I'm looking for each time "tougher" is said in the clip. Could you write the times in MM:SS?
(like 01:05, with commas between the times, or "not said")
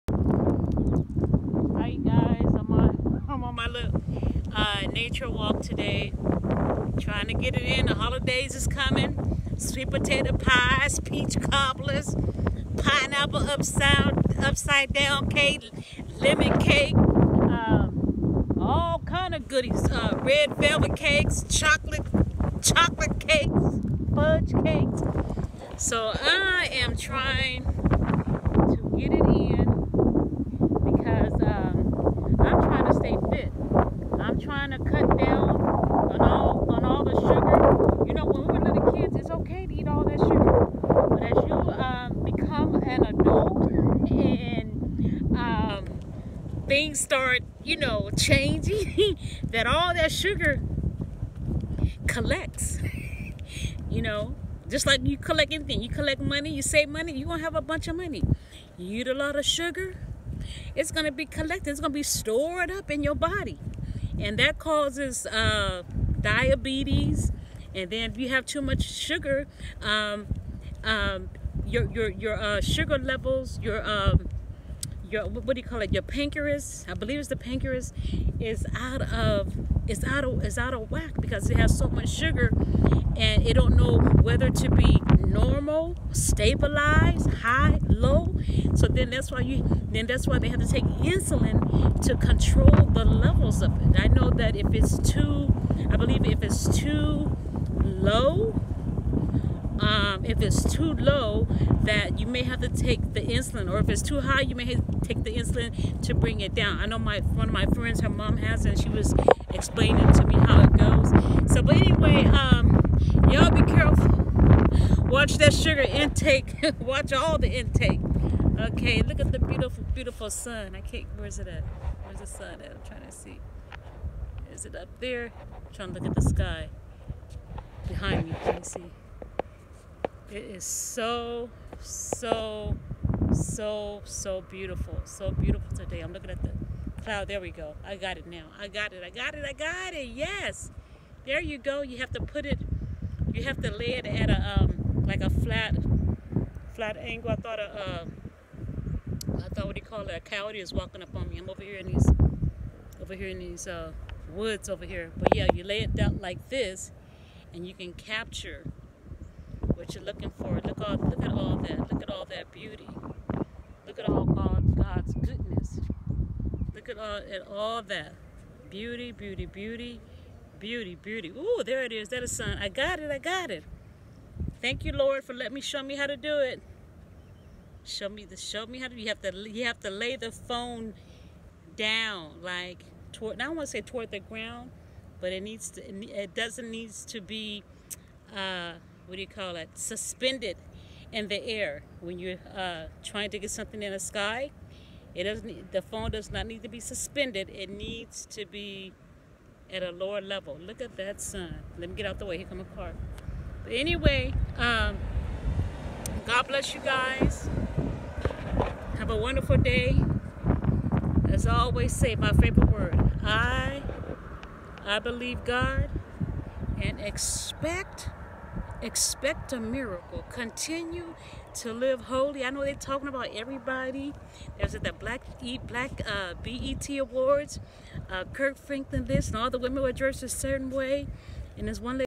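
not said.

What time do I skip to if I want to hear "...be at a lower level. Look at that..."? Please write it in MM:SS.
03:18.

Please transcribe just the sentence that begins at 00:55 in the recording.
You collect money, you save money, you're going to have a bunch of money.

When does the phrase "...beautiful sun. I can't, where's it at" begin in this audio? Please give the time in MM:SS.
01:59.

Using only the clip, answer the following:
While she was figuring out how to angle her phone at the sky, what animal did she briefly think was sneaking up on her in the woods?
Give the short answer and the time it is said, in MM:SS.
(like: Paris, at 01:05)
coyote, at 02:30.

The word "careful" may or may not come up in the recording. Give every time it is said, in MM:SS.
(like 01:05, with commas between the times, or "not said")
01:53.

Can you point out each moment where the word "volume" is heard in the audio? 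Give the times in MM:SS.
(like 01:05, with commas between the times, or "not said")
not said.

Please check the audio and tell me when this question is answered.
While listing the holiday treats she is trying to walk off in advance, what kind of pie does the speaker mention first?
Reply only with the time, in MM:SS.
00:09.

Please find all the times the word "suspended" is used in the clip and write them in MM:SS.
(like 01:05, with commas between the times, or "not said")
03:09, 03:16.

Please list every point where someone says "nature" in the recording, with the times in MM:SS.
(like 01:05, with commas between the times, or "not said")
00:04.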